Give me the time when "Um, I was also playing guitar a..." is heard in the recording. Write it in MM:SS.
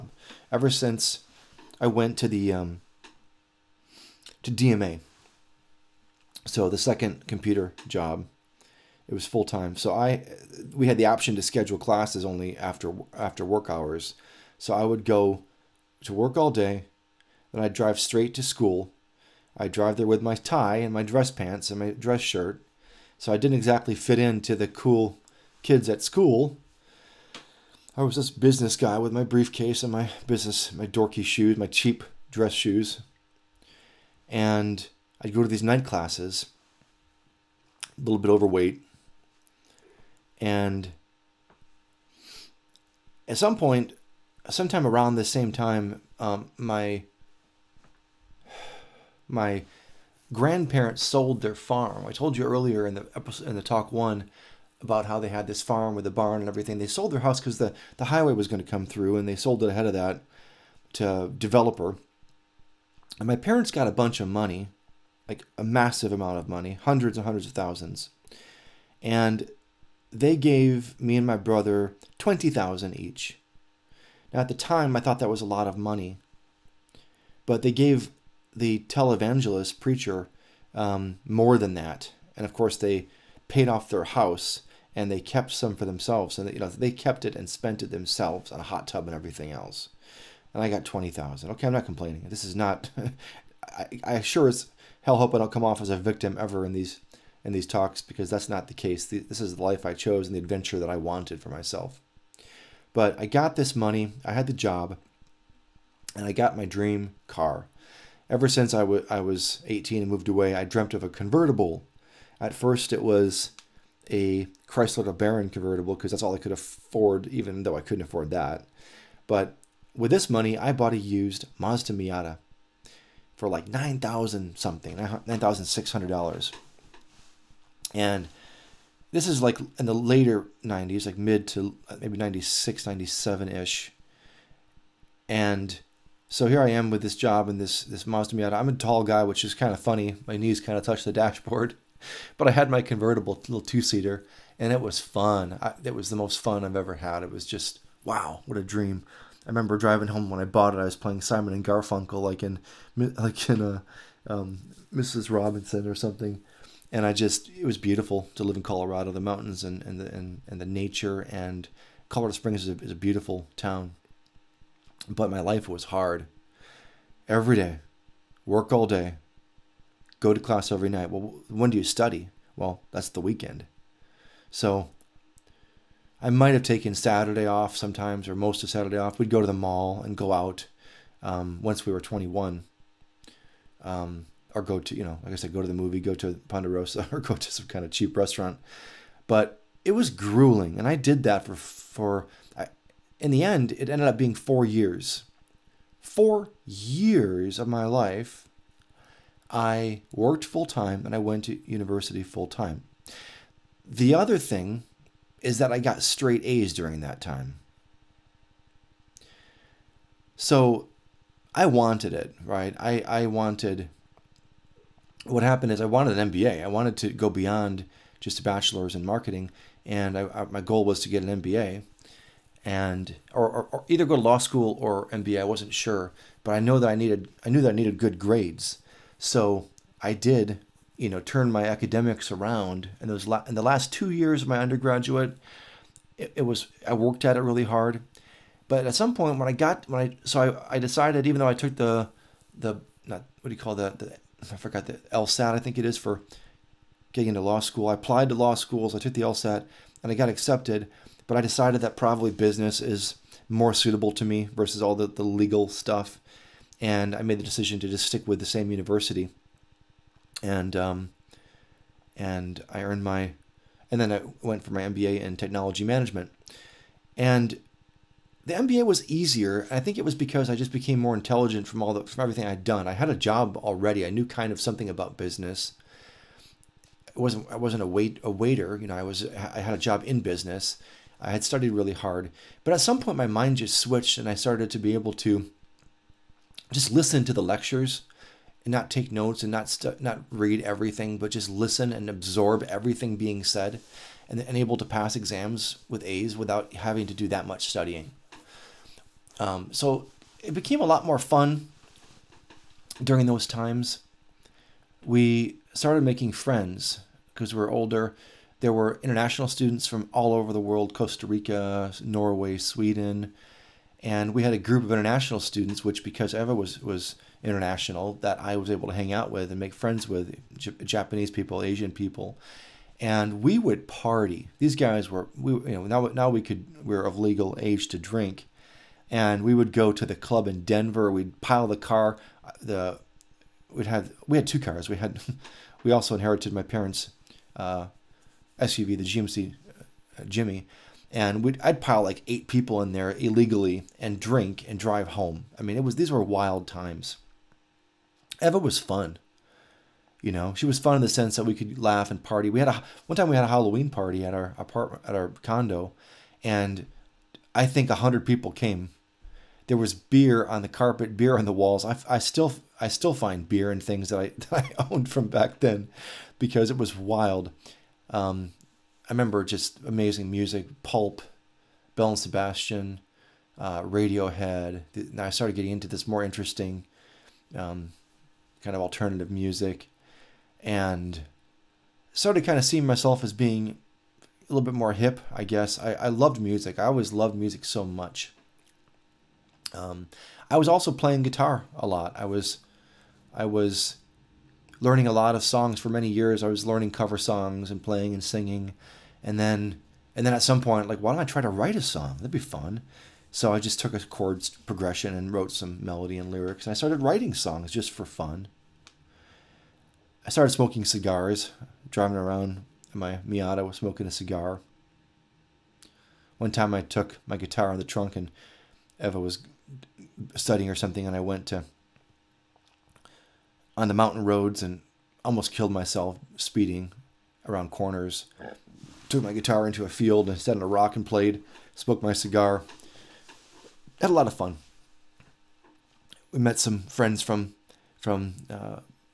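06:29.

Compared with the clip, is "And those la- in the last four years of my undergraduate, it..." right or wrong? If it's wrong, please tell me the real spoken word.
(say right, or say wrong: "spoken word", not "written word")
wrong: "two", not "four".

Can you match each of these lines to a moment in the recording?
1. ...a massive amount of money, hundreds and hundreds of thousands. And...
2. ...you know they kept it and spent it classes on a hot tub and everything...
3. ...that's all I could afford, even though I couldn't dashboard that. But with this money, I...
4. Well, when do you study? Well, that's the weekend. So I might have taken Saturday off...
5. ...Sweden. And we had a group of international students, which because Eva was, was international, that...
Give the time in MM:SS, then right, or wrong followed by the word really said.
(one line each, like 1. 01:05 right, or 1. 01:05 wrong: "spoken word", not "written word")
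1. 01:05 right
2. 01:26 wrong: "themselves", not "classes"
3. 01:56 wrong: "afford", not "dashboard"
4. 02:51 right
5. 05:12 right.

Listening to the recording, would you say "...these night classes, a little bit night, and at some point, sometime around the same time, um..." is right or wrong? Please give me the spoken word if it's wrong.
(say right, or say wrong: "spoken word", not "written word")
wrong: "overweight", not "night".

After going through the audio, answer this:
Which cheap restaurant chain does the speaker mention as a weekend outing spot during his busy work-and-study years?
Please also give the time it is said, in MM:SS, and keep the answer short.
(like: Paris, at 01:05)
Ponderosa, at 03:06.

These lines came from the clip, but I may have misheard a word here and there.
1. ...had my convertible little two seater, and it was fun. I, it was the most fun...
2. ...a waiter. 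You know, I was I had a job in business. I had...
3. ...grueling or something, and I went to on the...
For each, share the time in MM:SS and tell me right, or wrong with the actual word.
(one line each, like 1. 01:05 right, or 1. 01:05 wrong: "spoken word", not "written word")
1. 02:22 right
2. 04:38 right
3. 07:00 wrong: "studying", not "grueling".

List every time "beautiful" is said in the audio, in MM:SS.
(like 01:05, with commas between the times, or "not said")
02:37, 02:42.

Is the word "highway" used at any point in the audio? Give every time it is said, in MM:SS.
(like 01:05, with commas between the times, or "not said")
00:58.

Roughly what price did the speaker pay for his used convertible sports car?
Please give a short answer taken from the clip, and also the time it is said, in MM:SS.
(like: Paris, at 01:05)
$9,600, at 02:04.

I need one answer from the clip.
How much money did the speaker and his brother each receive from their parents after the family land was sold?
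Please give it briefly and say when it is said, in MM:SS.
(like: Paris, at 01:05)
20,000, at 01:12.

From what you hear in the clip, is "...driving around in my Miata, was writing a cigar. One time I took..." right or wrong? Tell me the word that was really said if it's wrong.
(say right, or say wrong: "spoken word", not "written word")
wrong: "smoking", not "writing".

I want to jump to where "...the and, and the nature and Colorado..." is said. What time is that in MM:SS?
02:40.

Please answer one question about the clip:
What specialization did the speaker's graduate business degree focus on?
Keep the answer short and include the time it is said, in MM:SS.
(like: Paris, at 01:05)
Technology management, at 04:25.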